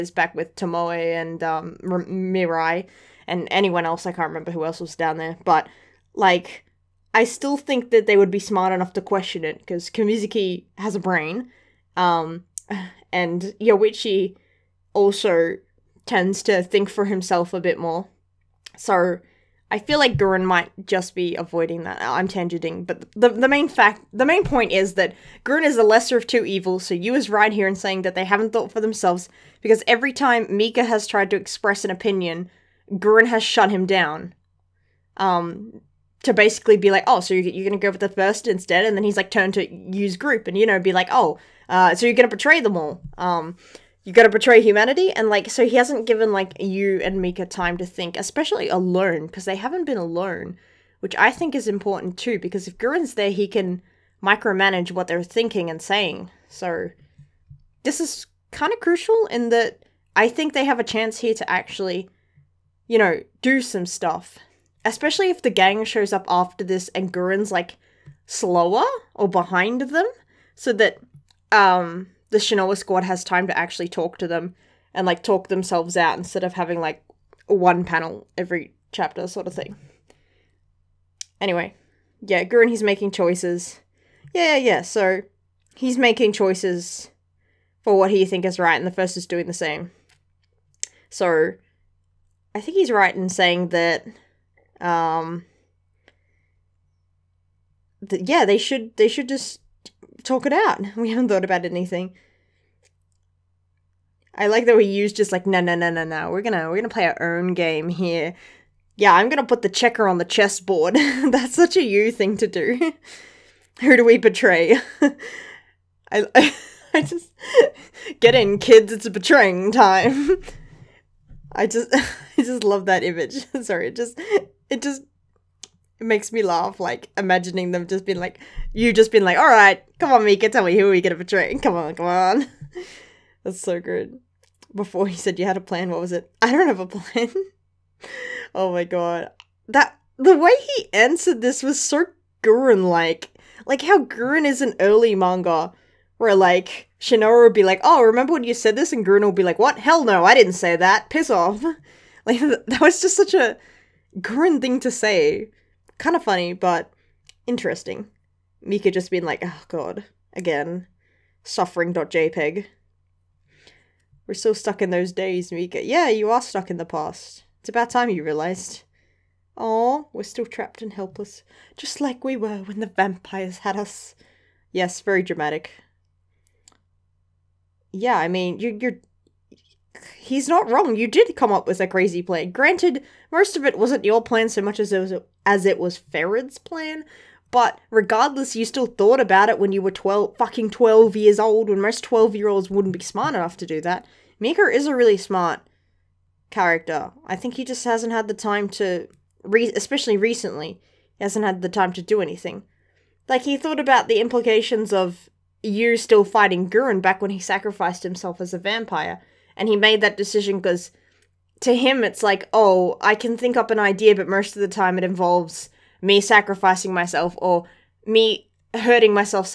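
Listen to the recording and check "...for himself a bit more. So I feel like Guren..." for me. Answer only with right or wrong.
right.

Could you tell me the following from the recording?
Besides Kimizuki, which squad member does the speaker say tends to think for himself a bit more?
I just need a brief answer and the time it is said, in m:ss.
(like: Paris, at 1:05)
Yoichi, at 0:13.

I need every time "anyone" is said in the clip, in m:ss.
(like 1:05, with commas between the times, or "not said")
0:03.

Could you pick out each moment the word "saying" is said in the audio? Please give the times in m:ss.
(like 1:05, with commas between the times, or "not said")
0:27, 0:55, 1:33.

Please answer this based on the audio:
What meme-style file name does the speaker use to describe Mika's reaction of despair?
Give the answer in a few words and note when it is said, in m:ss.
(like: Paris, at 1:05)
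suffering.jpg, at 2:41.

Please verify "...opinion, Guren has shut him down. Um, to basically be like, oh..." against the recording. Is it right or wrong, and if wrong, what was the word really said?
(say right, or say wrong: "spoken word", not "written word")
right.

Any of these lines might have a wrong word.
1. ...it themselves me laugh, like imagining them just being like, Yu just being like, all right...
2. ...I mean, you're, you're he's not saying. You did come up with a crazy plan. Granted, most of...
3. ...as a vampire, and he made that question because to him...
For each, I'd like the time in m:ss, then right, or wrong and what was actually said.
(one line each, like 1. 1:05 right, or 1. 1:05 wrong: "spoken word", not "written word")
1. 2:05 wrong: "makes", not "themselves"
2. 2:58 wrong: "wrong", not "saying"
3. 3:28 wrong: "decision", not "question".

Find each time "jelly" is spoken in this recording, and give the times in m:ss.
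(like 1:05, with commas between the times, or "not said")
not said.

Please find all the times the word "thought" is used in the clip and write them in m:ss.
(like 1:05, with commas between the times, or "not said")
0:28, 1:41, 3:08, 3:23.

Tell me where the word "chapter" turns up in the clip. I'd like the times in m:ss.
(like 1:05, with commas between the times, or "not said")
1:18.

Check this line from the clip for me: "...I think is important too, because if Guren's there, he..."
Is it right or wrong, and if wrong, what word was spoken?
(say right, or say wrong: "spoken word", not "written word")
right.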